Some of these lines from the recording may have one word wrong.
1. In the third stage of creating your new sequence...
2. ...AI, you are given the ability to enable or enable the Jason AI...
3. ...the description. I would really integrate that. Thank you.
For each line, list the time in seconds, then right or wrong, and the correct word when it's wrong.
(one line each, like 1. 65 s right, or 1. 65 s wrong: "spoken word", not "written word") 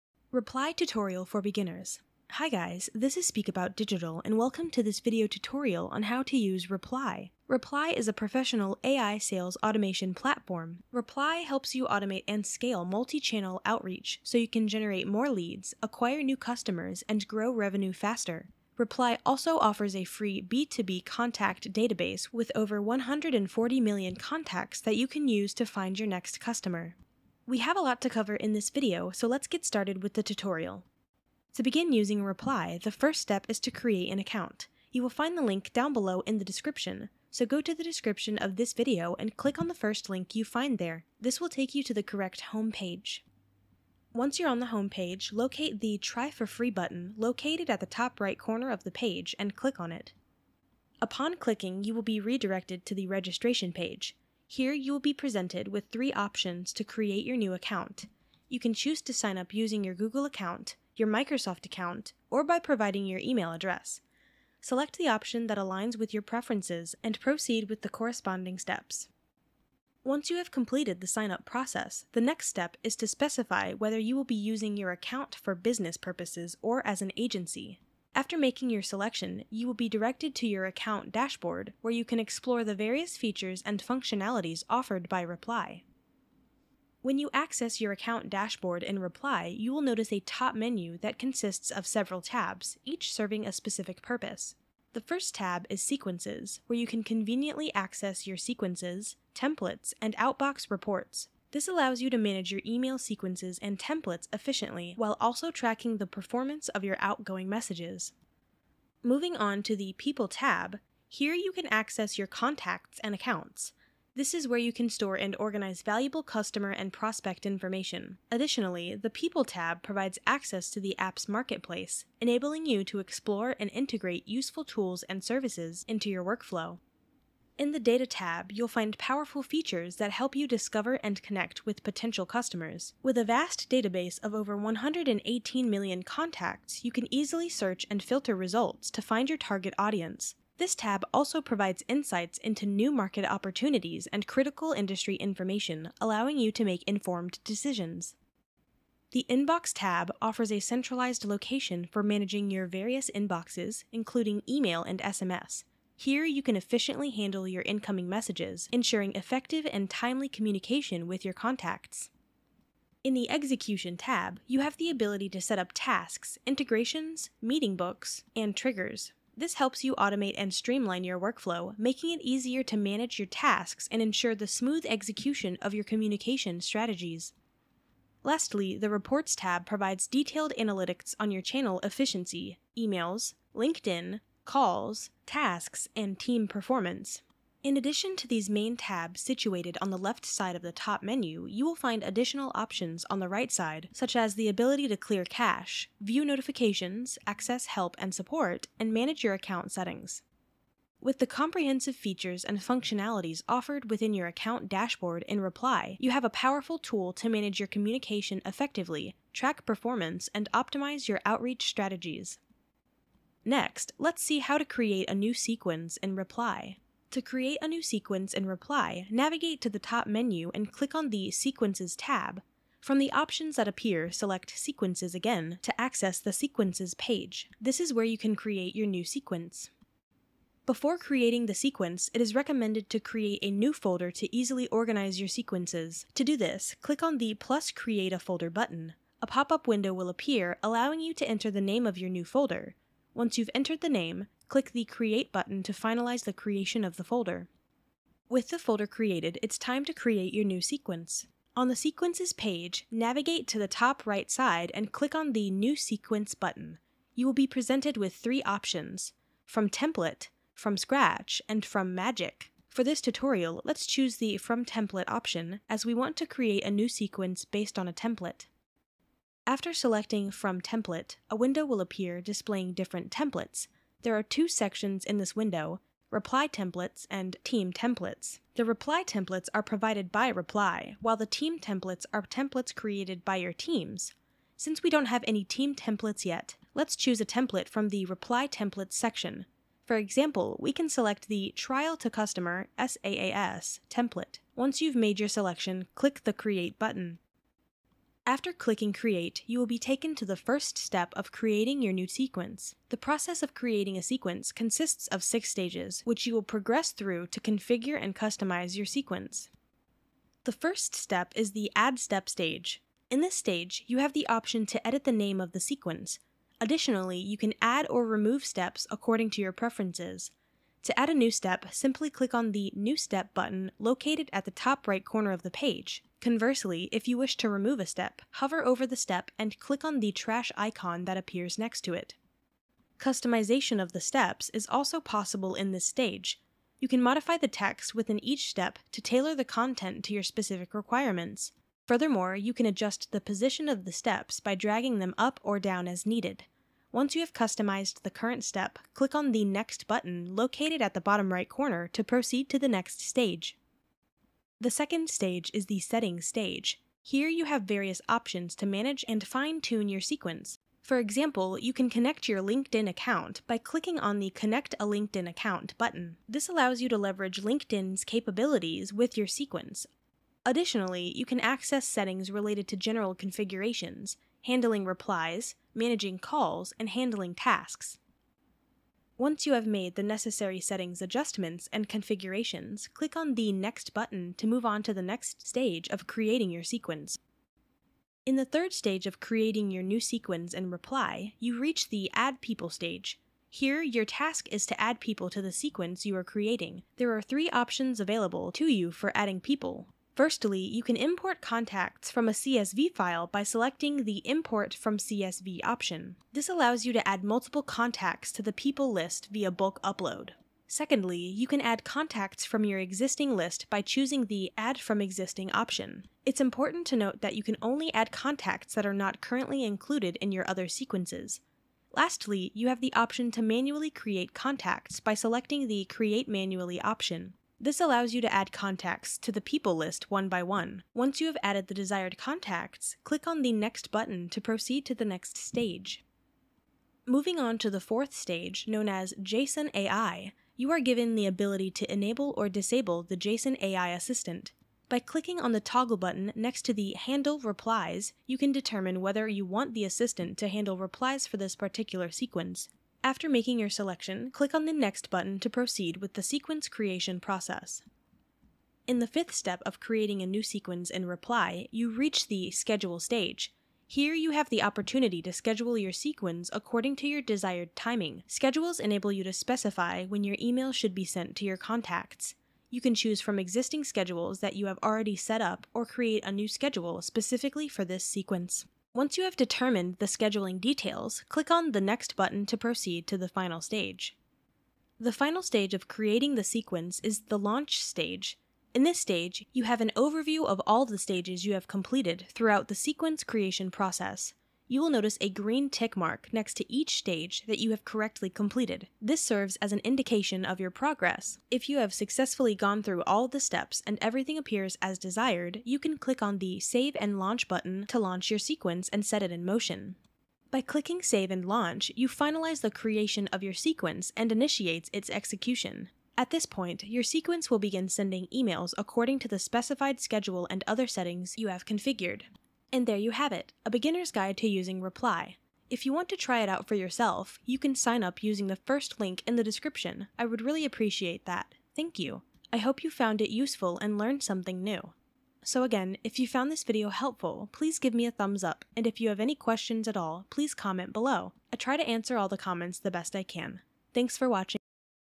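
1. 388 s right
2. 439 s wrong: "disable", not "enable"
3. 529 s wrong: "appreciate", not "integrate".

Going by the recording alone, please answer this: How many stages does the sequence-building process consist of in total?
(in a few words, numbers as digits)
6.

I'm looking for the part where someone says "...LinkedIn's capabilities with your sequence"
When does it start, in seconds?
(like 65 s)
367 s.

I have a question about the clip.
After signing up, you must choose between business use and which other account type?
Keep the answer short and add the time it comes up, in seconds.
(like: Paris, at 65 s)
Agency, at 77 s.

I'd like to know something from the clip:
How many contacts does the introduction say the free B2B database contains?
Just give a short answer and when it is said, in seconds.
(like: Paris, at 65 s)
140 million, at 22 s.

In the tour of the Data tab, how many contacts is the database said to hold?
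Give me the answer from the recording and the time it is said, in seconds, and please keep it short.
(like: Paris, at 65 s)
118 million, at 134 s.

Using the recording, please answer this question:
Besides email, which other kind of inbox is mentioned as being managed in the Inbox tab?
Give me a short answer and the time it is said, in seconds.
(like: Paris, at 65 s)
SMS, at 154 s.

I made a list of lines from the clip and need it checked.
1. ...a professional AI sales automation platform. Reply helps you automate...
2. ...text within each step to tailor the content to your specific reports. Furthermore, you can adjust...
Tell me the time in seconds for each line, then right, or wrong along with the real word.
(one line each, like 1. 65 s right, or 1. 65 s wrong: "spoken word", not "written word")
1. 8 s right
2. 337 s wrong: "requirements", not "reports".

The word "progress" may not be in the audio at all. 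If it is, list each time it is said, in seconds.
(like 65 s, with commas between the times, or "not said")
306 s, 500 s.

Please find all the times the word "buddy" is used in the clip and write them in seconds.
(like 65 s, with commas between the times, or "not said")
not said.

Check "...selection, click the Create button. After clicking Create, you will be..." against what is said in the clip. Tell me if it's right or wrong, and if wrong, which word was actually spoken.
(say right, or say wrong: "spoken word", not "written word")
right.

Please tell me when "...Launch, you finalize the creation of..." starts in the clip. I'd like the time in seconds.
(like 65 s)
511 s.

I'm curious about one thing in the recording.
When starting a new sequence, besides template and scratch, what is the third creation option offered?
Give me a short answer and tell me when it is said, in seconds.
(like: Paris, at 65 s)
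From Magic, at 261 s.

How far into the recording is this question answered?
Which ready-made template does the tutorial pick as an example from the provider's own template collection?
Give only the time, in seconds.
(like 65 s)
291 s.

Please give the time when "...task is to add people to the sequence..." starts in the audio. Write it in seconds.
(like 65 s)
394 s.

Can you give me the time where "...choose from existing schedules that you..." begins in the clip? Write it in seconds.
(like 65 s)
472 s.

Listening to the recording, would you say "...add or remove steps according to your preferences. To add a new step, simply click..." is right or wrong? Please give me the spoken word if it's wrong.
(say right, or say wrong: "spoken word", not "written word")
right.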